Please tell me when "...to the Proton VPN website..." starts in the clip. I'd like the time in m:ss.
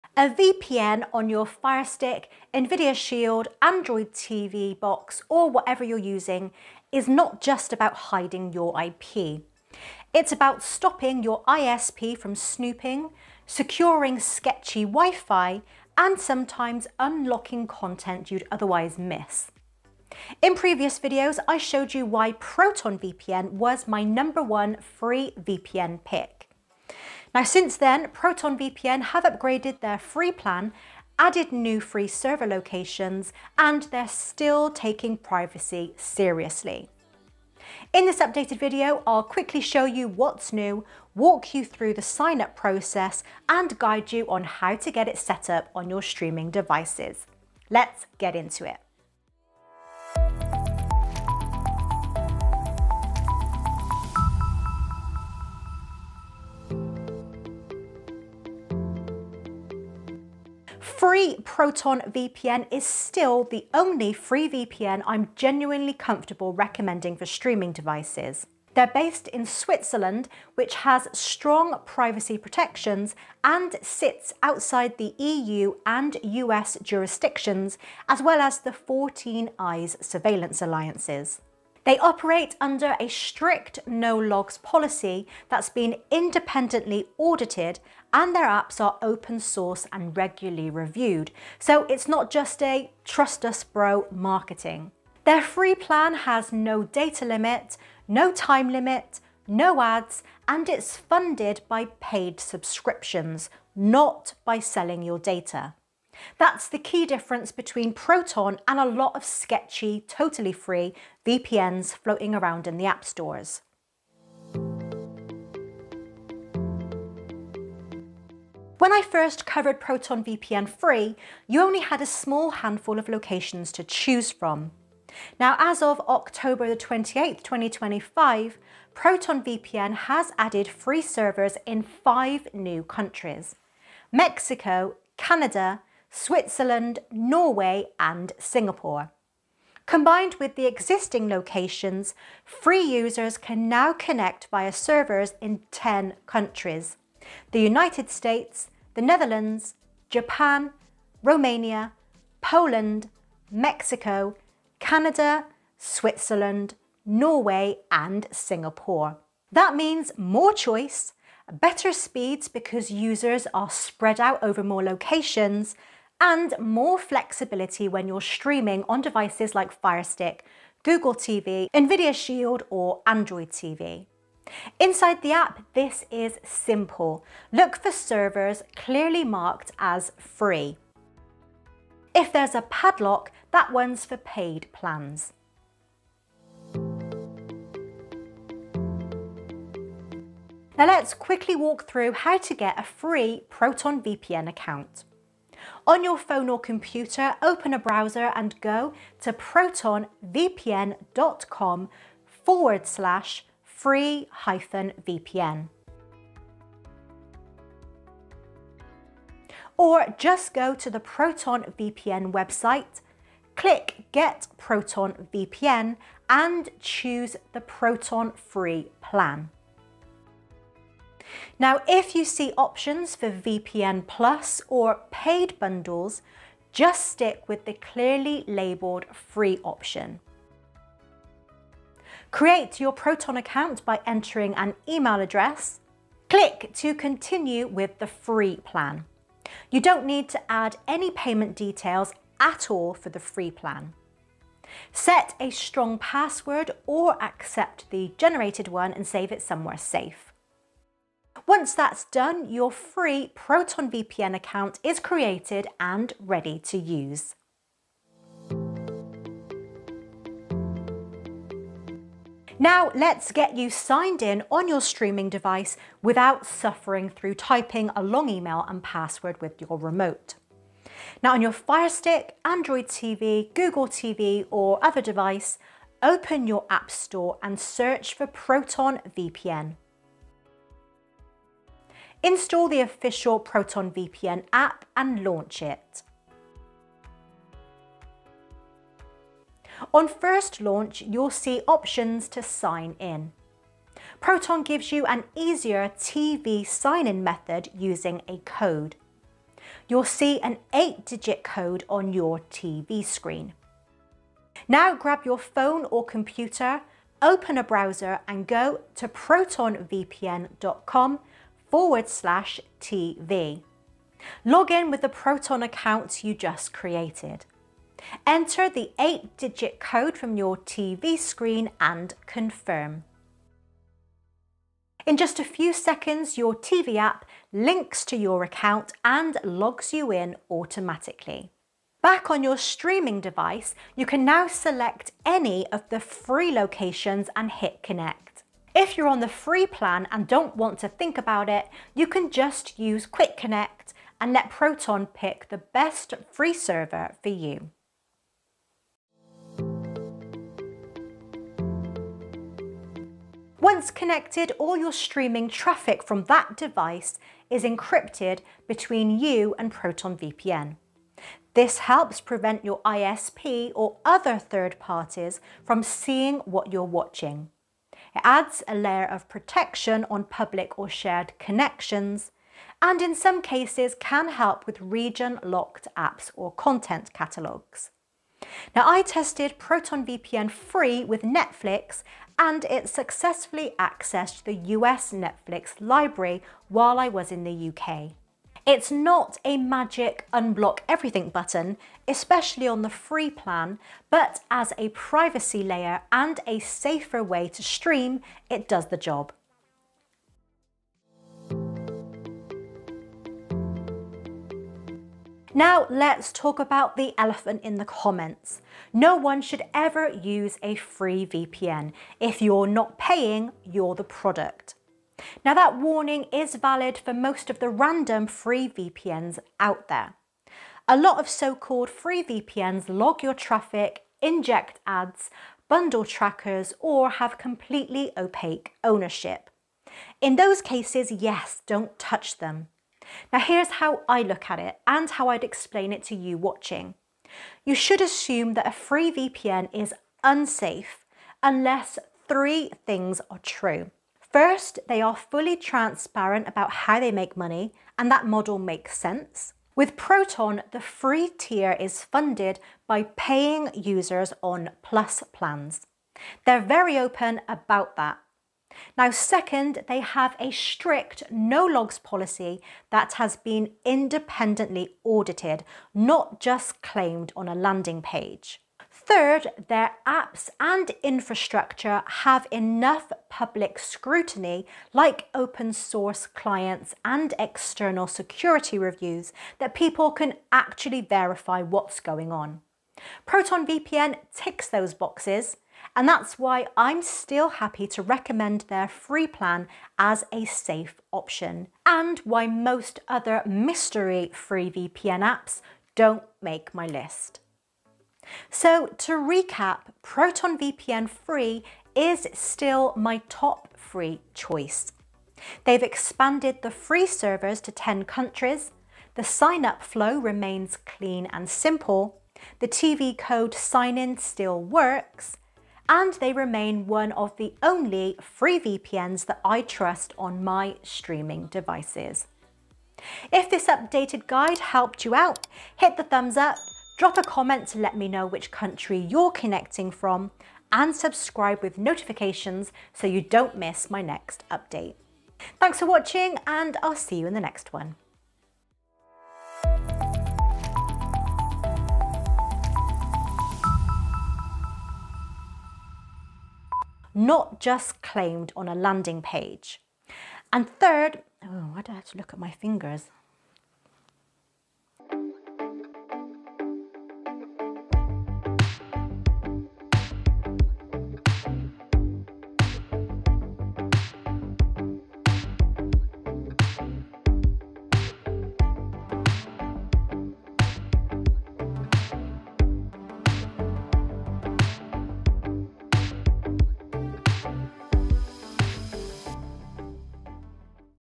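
3:30.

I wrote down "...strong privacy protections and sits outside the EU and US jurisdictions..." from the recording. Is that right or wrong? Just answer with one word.
right.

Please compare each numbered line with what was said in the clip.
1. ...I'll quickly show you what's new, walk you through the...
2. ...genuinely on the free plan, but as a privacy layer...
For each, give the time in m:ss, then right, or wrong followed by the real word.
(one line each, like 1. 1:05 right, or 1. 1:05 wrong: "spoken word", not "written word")
1. 0:39 right
2. 6:32 wrong: "especially", not "genuinely".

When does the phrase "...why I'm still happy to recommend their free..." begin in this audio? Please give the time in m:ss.
8:06.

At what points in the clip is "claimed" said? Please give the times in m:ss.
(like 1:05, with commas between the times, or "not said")
7:46, 9:08.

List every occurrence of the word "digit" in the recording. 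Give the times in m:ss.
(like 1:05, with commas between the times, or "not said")
5:00, 5:18.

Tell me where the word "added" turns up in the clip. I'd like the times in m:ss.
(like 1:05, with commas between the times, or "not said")
0:31, 2:10.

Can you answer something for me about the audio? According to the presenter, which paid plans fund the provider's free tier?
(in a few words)
Plus plans.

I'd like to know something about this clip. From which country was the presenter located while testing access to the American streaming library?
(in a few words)
UK.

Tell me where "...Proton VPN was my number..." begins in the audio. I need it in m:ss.
0:22.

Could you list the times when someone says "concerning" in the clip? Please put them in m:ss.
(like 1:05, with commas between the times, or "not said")
not said.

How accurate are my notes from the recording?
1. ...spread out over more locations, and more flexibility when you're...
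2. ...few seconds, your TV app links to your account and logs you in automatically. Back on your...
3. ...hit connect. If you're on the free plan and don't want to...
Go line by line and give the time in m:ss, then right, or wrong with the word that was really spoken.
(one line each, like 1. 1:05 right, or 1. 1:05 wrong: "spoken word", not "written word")
1. 2:43 right
2. 5:25 right
3. 5:37 right.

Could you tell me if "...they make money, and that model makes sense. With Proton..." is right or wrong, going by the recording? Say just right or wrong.
right.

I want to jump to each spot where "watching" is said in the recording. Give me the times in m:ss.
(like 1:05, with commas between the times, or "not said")
6:06, 7:16, 8:55.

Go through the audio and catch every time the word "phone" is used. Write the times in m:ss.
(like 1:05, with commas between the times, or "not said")
3:16, 5:05.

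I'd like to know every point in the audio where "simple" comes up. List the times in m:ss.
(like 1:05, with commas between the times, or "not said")
2:56, 8:31.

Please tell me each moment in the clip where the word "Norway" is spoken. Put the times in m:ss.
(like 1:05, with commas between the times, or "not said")
2:17, 2:37.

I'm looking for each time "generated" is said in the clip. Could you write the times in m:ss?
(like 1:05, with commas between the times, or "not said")
4:08.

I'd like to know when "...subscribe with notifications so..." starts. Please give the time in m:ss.
8:50.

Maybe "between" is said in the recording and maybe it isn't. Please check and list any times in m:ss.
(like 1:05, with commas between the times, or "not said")
1:47, 5:58.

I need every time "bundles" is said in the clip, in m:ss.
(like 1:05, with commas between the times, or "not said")
3:45, 7:05.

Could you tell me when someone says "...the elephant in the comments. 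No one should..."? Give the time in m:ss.
6:46.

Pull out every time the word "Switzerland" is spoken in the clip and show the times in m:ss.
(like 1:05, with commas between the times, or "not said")
1:09, 2:16, 2:35.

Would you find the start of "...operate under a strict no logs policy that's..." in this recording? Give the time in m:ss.
1:21.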